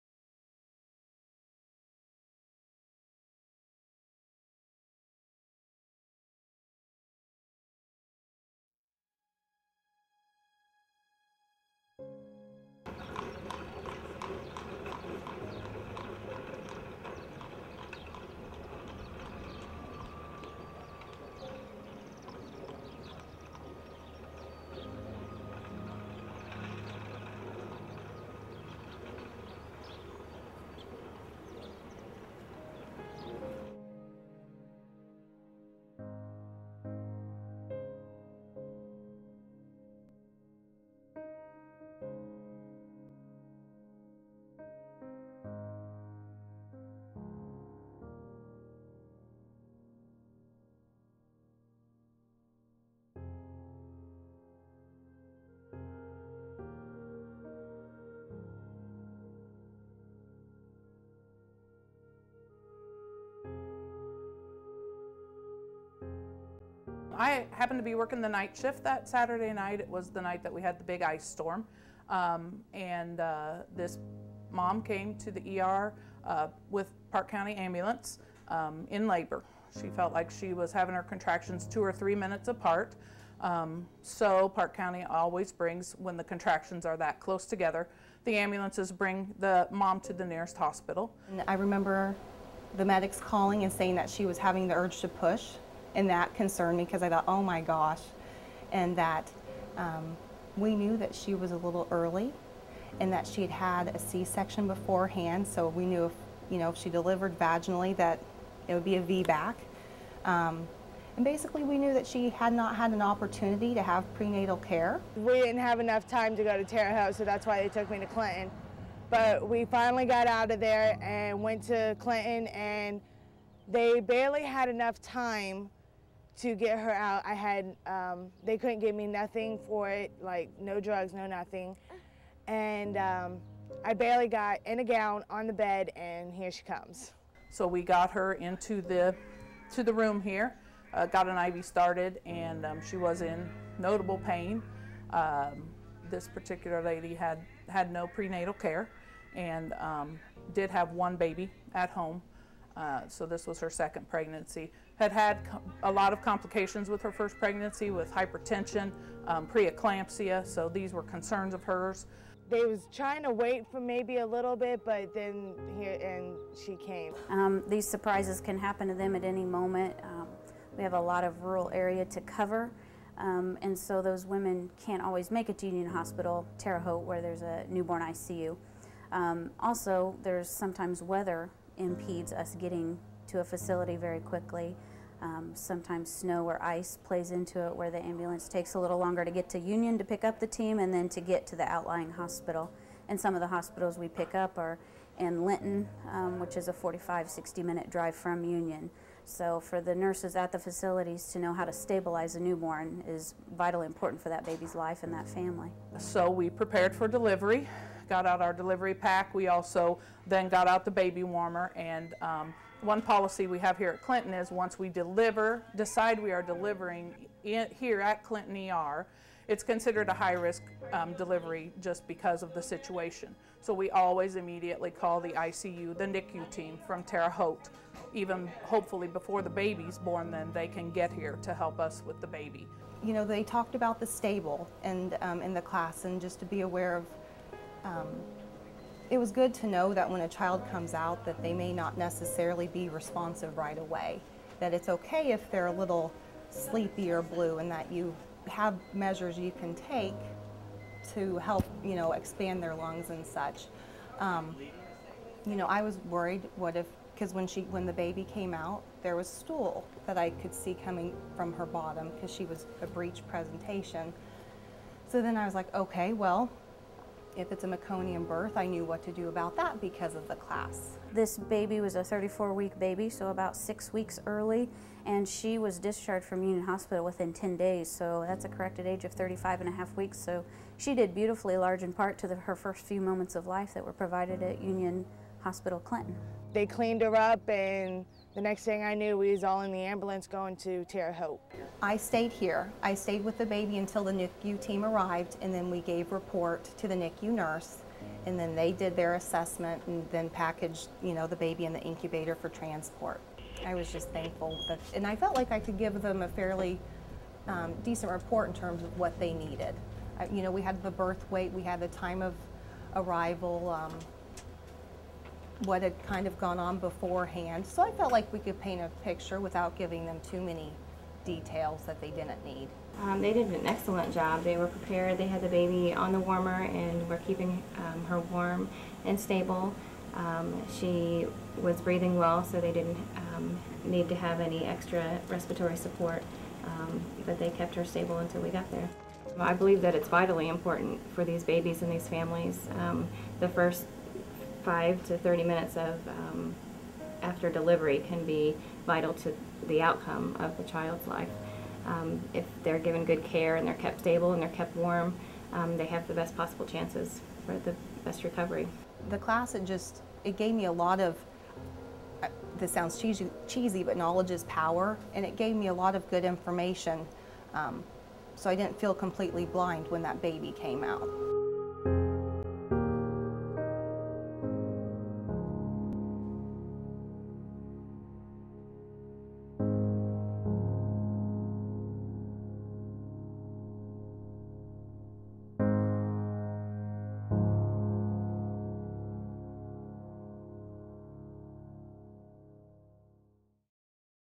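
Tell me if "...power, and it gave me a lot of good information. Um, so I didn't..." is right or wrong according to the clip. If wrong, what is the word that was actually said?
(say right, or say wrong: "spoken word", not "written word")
right.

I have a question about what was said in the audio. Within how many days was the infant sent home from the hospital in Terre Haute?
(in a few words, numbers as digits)
10.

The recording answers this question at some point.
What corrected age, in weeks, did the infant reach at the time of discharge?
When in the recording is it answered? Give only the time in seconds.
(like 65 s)
279 s.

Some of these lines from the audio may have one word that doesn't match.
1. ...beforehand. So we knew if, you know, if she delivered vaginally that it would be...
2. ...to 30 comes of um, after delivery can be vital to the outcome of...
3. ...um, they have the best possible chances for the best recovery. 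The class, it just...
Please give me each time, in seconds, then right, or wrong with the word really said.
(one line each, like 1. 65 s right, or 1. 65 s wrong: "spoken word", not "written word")
1. 104 s right
2. 345 s wrong: "minutes", not "comes"
3. 355 s right.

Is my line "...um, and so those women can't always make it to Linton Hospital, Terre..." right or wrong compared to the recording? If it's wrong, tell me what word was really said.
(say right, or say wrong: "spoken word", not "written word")
wrong: "Union", not "Linton".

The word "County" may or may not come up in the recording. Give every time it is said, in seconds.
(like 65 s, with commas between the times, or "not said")
77 s, 84 s.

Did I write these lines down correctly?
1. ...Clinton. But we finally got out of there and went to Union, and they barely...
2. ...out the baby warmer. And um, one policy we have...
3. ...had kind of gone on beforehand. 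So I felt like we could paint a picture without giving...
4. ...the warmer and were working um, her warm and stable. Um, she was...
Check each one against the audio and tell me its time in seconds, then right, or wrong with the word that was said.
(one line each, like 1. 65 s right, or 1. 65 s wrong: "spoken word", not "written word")
1. 118 s wrong: "Clinton", not "Union"
2. 210 s right
3. 315 s right
4. 326 s wrong: "keeping", not "working".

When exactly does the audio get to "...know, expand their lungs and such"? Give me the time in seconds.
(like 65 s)
251 s.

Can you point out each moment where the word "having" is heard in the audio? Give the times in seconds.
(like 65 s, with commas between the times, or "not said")
80 s, 94 s.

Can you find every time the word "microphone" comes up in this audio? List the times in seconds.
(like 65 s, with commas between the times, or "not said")
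not said.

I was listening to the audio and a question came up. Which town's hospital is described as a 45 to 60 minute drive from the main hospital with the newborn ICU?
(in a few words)
Linton.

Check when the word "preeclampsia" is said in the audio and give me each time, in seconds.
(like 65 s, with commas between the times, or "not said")
159 s.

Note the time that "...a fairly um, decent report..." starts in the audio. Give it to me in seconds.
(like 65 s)
306 s.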